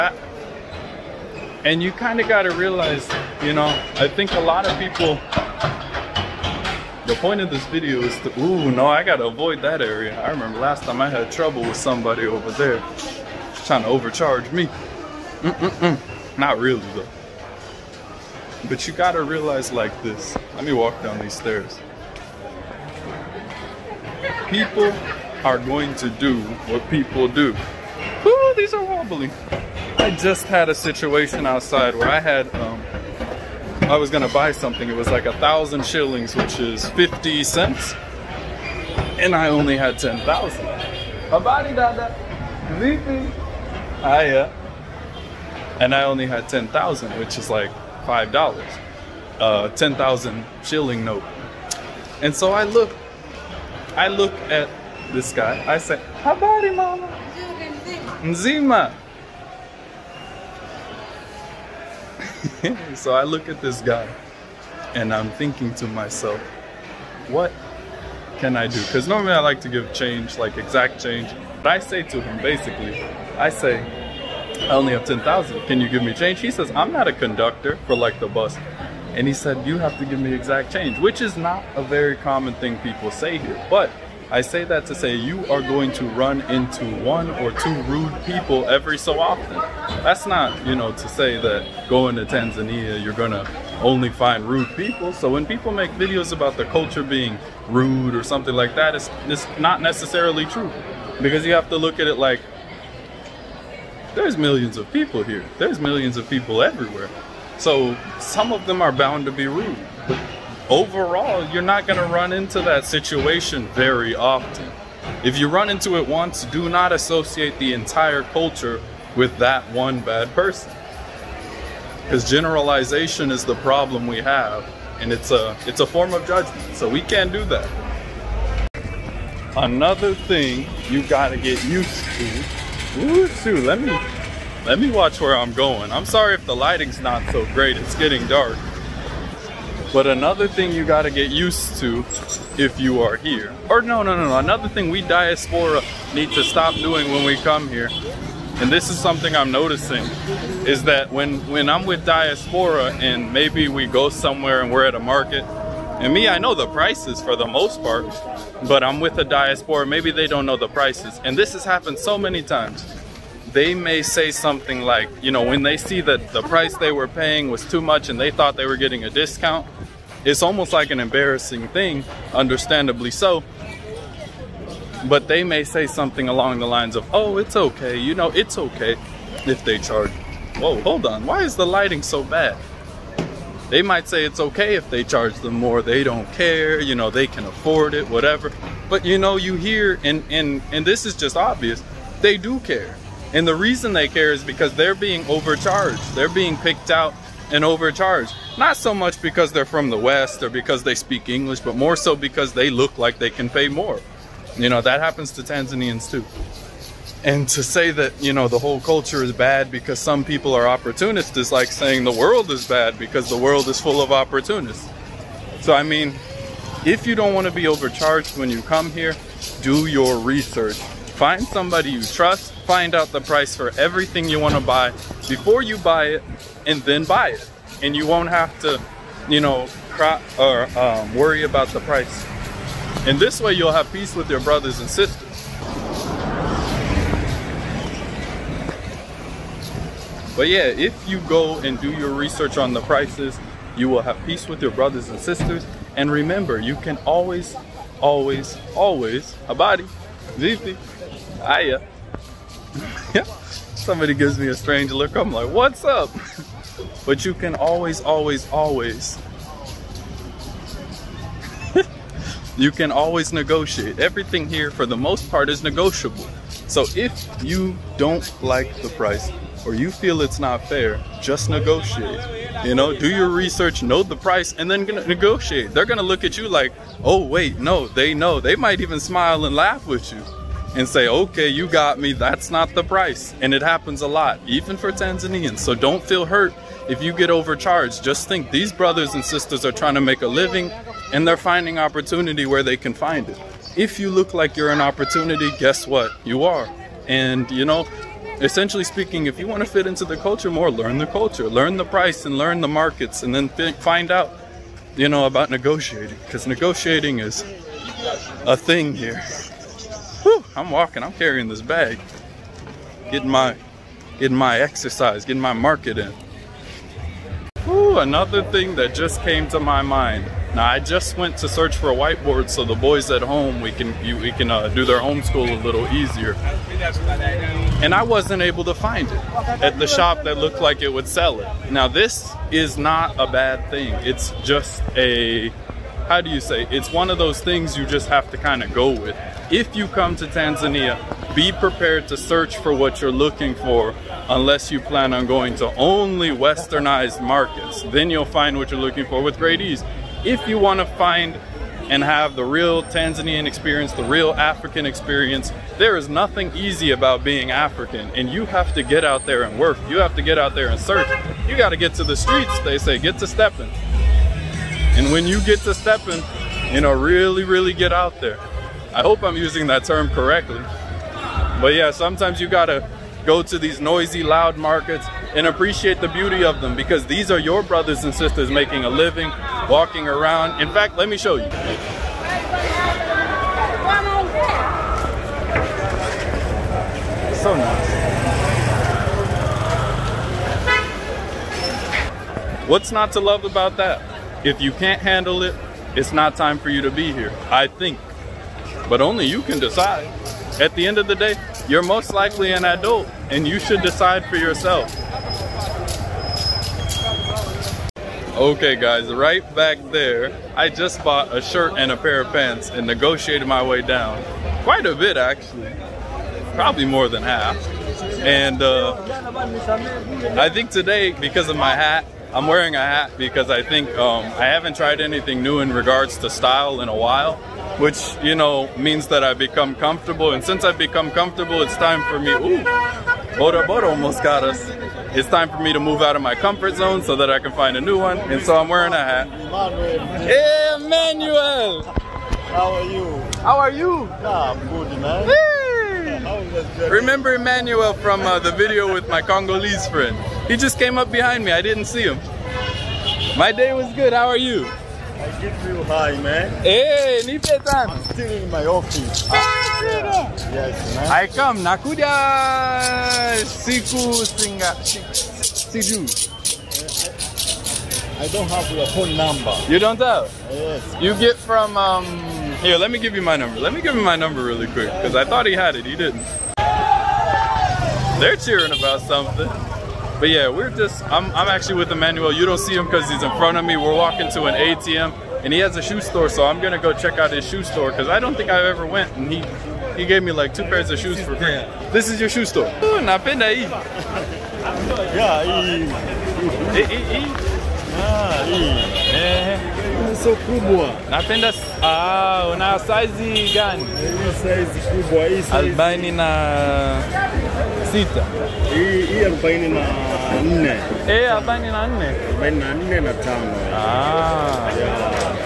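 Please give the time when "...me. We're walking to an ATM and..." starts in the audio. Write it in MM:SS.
08:03.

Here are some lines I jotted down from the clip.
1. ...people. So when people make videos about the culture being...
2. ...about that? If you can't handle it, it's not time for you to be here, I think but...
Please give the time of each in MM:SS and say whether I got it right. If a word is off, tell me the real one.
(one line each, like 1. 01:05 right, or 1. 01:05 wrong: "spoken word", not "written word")
1. 01:34 right
2. 06:33 right.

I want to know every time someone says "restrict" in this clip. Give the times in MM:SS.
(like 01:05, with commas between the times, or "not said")
not said.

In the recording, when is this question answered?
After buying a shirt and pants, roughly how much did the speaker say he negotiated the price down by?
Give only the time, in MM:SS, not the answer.
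06:56.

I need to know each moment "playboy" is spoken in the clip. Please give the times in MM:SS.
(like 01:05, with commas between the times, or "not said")
not said.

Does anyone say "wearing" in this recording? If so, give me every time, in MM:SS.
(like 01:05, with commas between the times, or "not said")
07:02, 07:18.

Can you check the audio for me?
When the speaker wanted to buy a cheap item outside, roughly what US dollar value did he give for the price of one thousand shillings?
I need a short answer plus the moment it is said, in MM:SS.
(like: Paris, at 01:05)
50 cents, at 00:36.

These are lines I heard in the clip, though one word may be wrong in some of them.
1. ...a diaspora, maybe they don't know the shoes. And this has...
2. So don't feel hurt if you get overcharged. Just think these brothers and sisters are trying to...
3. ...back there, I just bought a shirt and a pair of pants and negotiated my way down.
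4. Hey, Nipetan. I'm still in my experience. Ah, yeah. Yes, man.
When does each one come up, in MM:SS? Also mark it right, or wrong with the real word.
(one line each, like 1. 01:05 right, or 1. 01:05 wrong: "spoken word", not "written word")
1. 02:39 wrong: "prices", not "shoes"
2. 04:45 right
3. 06:49 right
4. 07:36 wrong: "office", not "experience".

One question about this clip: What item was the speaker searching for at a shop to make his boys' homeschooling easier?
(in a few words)
whiteboard.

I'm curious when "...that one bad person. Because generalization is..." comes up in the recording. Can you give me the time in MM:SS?
01:59.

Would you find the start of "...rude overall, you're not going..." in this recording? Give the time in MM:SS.
01:49.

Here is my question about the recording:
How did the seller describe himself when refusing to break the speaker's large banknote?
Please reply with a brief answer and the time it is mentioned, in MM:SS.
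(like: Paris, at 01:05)
a conductor, at 01:17.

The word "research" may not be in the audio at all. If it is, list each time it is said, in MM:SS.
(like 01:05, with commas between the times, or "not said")
03:40, 04:02, 04:33.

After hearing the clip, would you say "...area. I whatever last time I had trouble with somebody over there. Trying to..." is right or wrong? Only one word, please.
wrong.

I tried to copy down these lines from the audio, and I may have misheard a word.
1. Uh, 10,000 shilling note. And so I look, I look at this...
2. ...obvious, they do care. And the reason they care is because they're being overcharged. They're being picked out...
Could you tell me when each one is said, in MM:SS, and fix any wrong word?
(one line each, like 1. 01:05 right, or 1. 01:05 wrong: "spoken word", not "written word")
1. 00:49 right
2. 03:11 right.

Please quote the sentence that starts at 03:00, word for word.
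Whoa, hold on, why is the lighting so bad?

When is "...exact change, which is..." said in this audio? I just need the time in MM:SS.
01:20.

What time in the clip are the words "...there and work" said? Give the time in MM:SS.
05:59.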